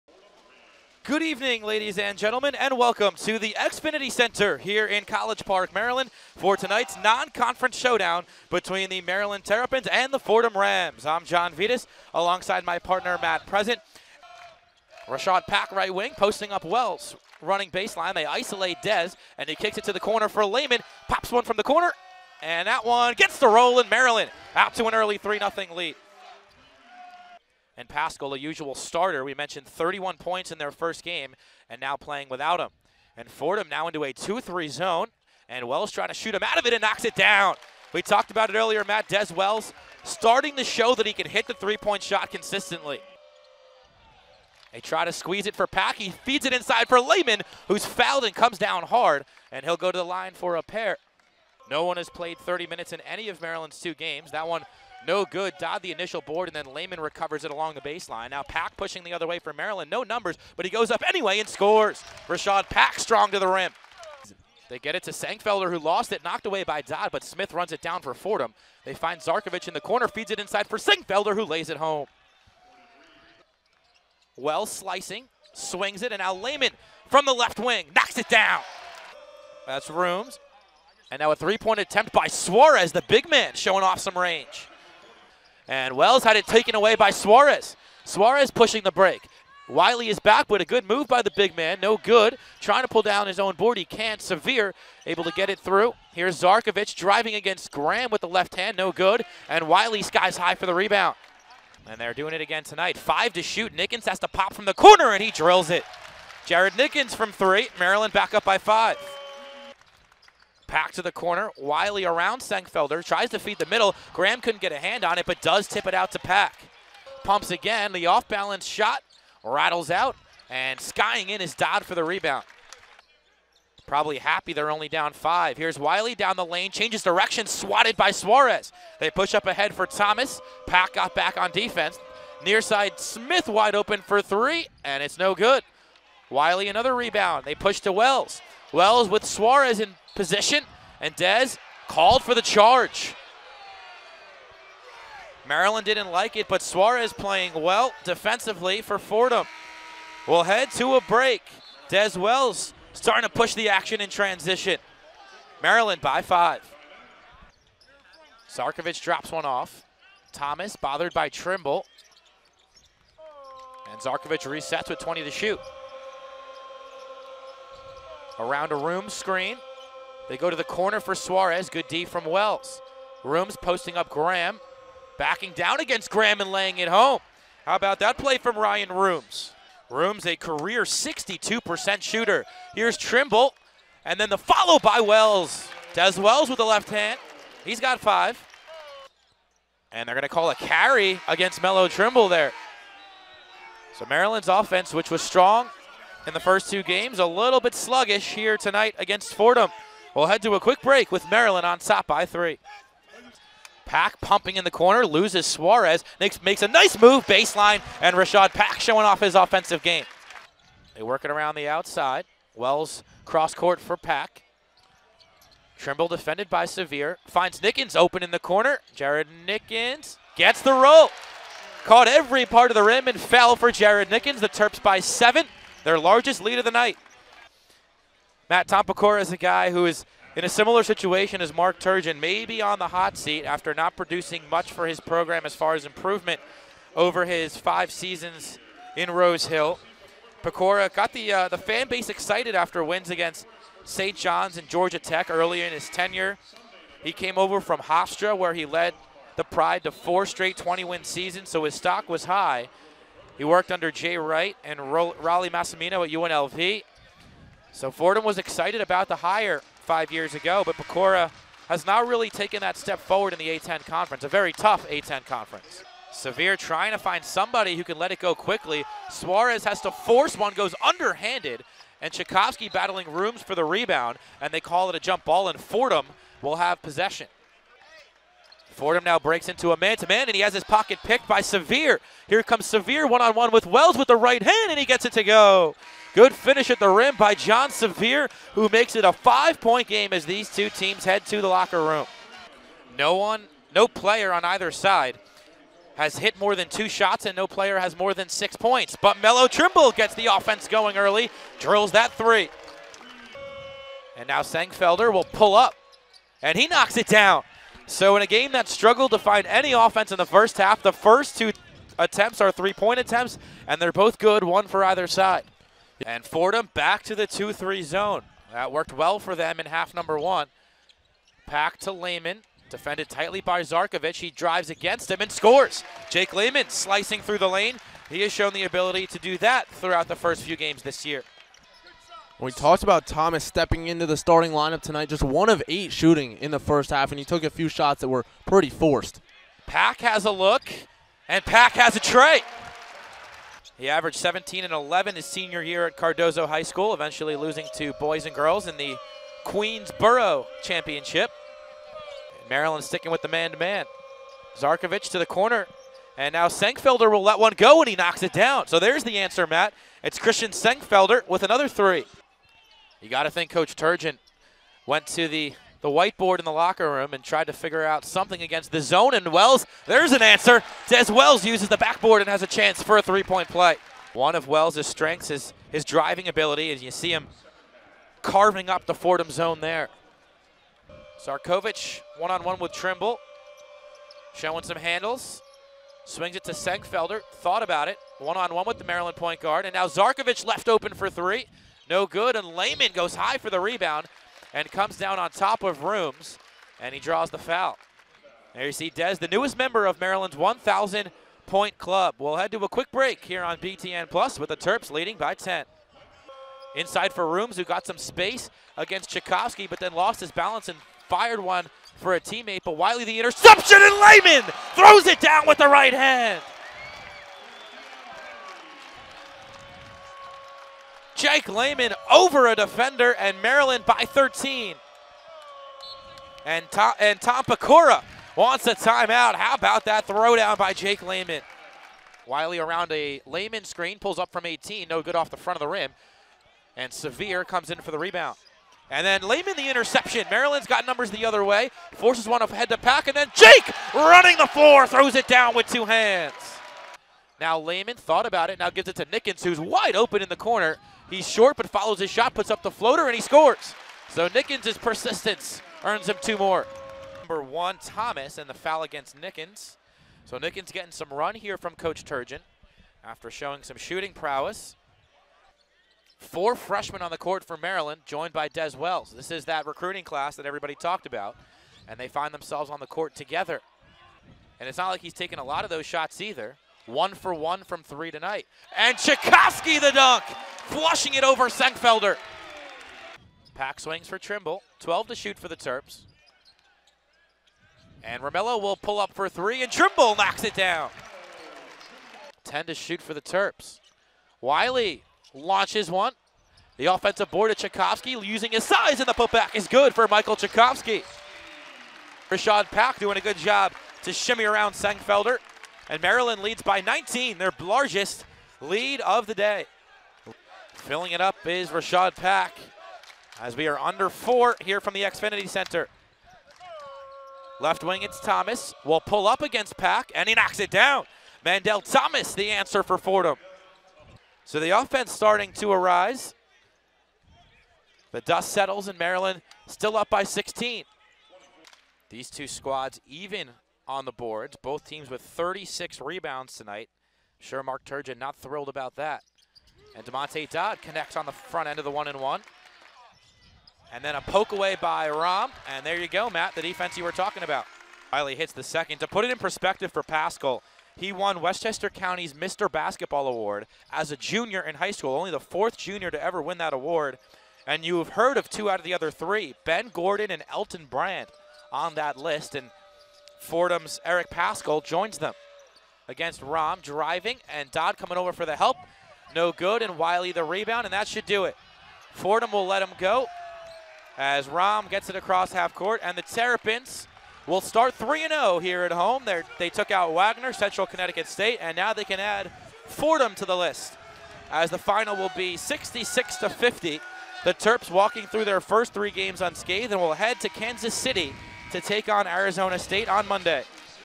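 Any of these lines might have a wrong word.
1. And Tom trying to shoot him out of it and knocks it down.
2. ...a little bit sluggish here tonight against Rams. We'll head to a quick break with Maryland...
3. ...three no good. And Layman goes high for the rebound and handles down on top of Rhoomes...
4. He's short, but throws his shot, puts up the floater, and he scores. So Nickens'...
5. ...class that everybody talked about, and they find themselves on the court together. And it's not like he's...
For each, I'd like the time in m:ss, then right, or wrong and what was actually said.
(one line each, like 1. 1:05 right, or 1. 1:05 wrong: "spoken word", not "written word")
1. 0:35 wrong: "Wells", not "Tom"
2. 3:17 wrong: "Fordham", not "Rams"
3. 6:31 wrong: "comes", not "handles"
4. 7:31 wrong: "follows", not "throws"
5. 7:50 right.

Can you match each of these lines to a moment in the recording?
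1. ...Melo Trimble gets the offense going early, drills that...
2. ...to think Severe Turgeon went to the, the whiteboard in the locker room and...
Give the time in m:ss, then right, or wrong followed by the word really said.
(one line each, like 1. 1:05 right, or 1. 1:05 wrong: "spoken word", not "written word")
1. 4:59 right
2. 6:03 wrong: "Coach", not "Severe".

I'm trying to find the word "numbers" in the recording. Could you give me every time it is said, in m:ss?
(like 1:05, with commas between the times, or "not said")
1:00, 5:19, 7:20, 7:37.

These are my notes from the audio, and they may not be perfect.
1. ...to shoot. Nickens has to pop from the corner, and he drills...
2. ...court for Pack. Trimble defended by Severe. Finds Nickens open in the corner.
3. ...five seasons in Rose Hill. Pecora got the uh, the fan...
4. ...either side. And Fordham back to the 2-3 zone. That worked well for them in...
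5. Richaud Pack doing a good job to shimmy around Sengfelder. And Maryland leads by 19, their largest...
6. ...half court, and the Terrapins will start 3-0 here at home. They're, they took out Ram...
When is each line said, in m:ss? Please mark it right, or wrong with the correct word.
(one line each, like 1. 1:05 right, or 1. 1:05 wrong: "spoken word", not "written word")
1. 1:43 right
2. 3:33 right
3. 3:57 right
4. 5:14 right
5. 8:22 right
6. 9:35 wrong: "Wagner", not "Ram".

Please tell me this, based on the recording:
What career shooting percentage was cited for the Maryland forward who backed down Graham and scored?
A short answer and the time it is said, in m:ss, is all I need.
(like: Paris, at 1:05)
62%, at 3:00.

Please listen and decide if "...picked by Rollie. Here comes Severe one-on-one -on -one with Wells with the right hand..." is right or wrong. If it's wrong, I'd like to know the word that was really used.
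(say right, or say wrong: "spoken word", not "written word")
wrong: "Severe", not "Rollie".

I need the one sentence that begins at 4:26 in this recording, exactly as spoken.
Severe trying to find somebody who can let it go quickly.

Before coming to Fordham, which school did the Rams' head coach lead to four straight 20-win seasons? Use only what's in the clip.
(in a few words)
Hofstra.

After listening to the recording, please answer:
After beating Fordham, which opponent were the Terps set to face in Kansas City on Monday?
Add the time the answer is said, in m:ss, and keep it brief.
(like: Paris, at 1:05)
Arizona State, at 9:52.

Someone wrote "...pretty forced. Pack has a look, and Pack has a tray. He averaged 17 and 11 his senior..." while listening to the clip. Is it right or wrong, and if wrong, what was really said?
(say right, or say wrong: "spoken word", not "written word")
right.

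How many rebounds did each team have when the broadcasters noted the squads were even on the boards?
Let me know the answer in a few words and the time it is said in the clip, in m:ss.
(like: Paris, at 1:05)
36, at 8:55.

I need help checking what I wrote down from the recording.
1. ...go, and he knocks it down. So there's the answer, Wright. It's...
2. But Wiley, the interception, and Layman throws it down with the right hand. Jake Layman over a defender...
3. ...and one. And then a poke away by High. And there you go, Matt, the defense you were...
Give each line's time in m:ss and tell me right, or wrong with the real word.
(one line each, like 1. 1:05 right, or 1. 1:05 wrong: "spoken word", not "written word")
1. 5:57 wrong: "Matt", not "Wright"
2. 6:52 right
3. 9:02 wrong: "Ram", not "High".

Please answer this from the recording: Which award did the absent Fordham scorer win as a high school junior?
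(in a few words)
Westchester County's Mr. Basketball.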